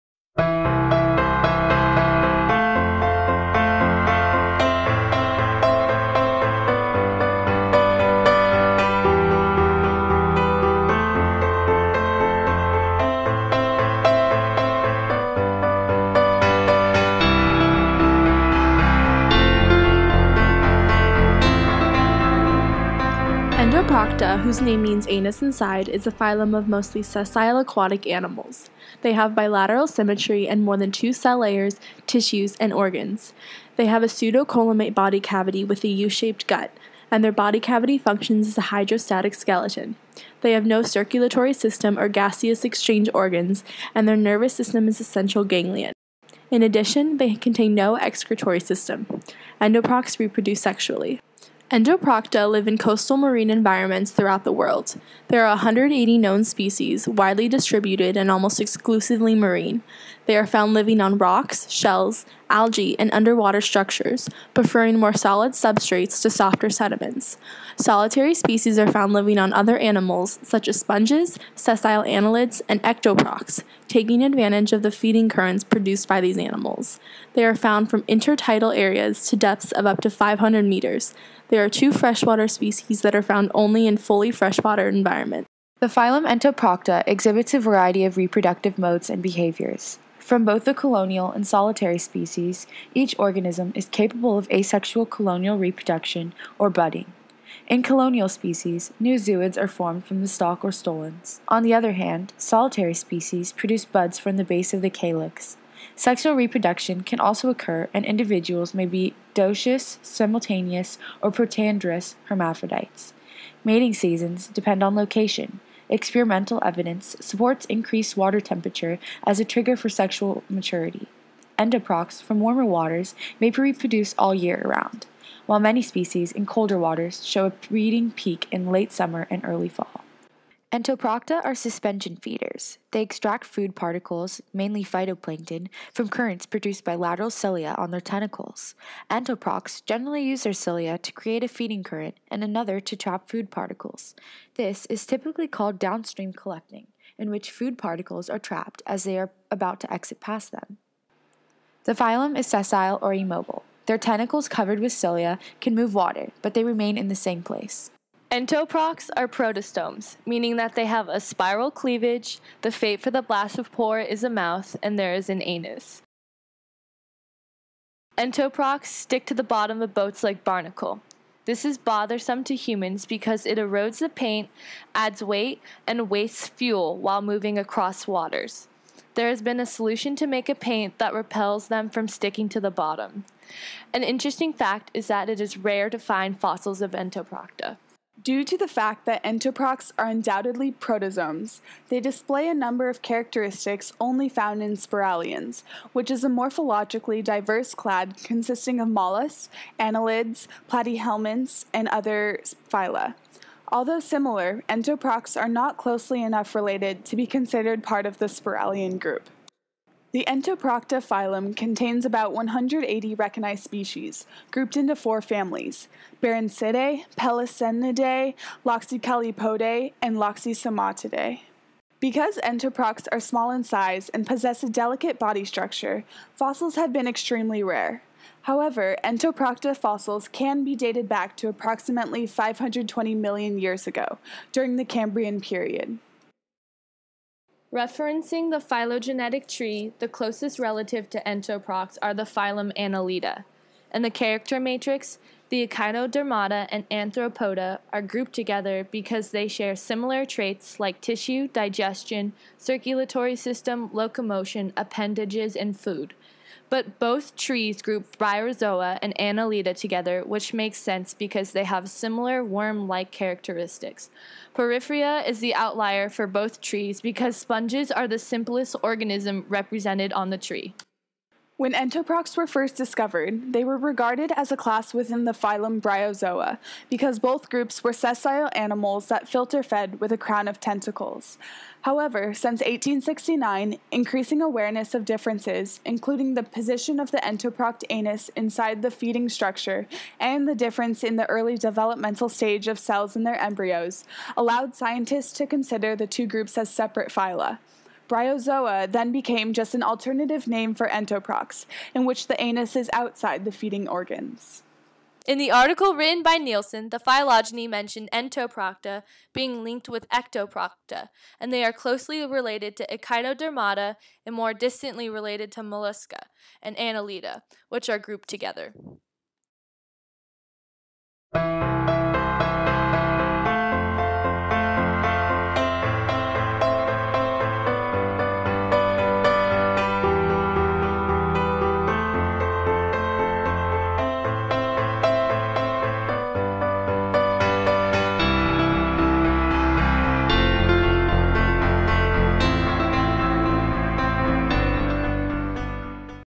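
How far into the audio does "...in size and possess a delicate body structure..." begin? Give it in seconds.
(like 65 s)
223 s.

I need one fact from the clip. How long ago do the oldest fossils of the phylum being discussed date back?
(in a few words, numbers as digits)
520 million years.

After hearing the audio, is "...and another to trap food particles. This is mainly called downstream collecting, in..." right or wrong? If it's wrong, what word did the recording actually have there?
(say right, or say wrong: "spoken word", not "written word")
wrong: "typically", not "mainly".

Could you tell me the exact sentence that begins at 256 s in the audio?
But both trees group Bryozoa and Annelida together, which makes sense because they have similar worm like characteristics.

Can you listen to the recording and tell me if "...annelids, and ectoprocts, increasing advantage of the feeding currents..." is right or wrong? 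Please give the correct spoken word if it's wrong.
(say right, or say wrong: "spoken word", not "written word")
wrong: "taking", not "increasing".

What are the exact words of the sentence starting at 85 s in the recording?
The phylum Entoprocta exhibits a variety of reproductive modes and behaviors.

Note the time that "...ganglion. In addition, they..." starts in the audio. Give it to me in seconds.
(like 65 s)
45 s.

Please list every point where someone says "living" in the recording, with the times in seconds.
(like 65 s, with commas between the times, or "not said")
60 s, 69 s.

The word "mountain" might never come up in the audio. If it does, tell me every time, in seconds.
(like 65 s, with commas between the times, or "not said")
not said.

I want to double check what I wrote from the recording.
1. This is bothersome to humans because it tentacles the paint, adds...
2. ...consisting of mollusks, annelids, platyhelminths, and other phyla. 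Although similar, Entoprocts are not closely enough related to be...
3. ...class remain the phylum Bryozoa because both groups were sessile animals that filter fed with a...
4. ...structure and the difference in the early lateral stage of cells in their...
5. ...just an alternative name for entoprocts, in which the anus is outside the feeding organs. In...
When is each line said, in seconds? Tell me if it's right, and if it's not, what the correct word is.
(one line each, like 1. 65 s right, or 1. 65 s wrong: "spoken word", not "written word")
1. 171 s wrong: "erodes", not "tentacles"
2. 198 s right
3. 274 s wrong: "within", not "remain"
4. 289 s wrong: "developmental", not "lateral"
5. 299 s right.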